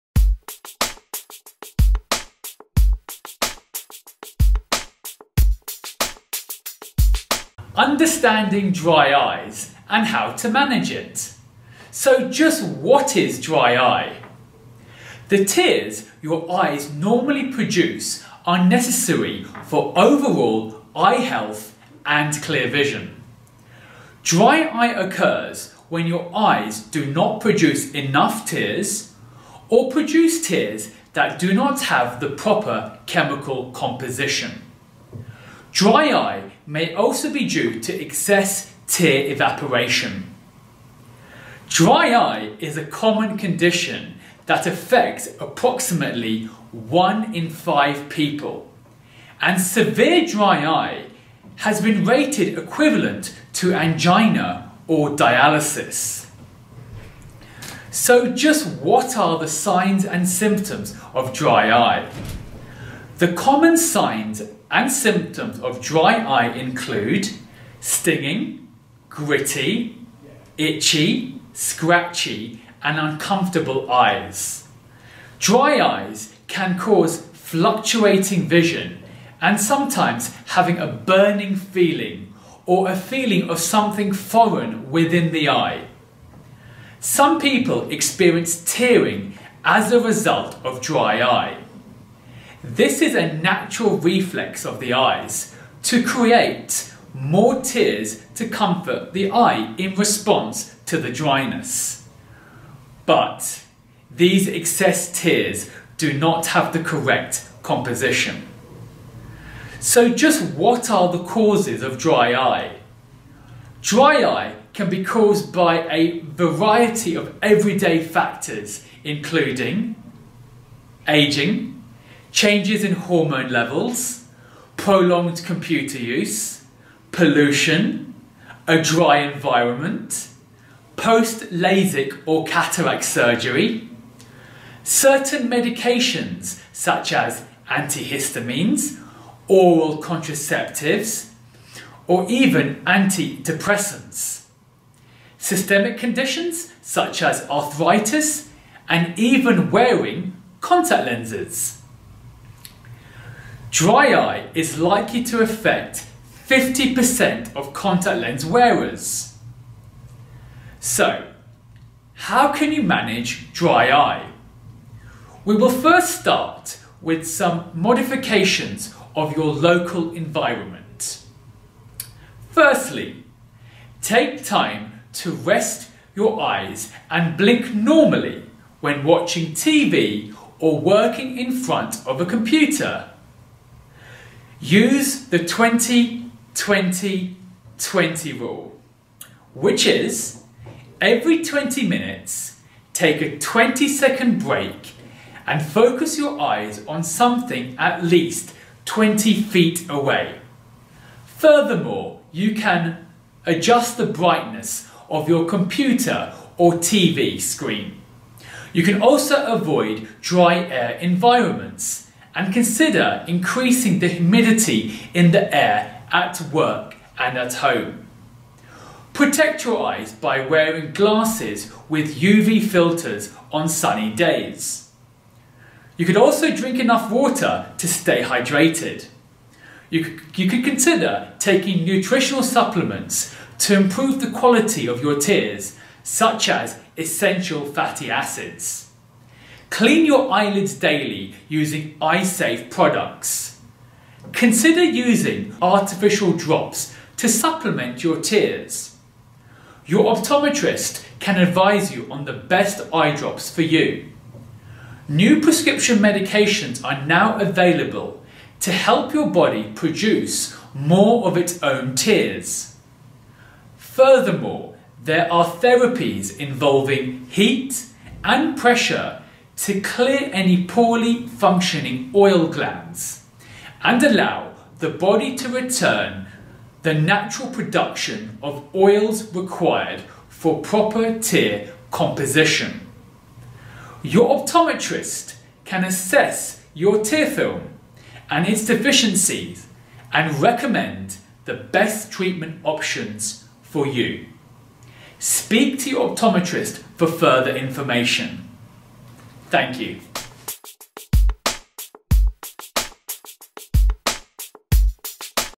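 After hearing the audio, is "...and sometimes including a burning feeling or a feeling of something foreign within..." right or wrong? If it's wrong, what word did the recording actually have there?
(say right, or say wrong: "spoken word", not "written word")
wrong: "having", not "including".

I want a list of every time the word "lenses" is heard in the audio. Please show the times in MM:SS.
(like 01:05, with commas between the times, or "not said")
02:31.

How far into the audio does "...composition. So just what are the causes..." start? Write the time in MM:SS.
01:47.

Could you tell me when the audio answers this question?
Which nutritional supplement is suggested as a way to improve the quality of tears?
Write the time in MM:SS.
03:56.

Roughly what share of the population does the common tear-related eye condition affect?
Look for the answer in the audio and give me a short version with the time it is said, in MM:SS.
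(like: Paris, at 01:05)
1 in 5, at 00:46.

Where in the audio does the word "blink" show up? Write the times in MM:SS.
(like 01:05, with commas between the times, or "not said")
02:57.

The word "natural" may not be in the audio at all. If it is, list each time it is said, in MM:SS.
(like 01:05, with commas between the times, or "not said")
01:33, 04:36.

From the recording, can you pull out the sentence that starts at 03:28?
You can also avoid dry air environments and consider increasing the humidity in the air at work and at home.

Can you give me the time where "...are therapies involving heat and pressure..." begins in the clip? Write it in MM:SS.
04:25.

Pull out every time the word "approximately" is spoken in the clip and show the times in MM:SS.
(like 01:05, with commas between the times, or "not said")
00:45.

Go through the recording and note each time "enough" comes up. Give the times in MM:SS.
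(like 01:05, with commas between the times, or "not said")
00:27, 03:46.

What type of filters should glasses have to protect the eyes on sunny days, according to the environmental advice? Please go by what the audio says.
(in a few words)
UV filters.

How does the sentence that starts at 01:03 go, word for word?
The common signs and symptoms of dry eye include stinging, gritty, itchy, scratchy, and uncomfortable eyes.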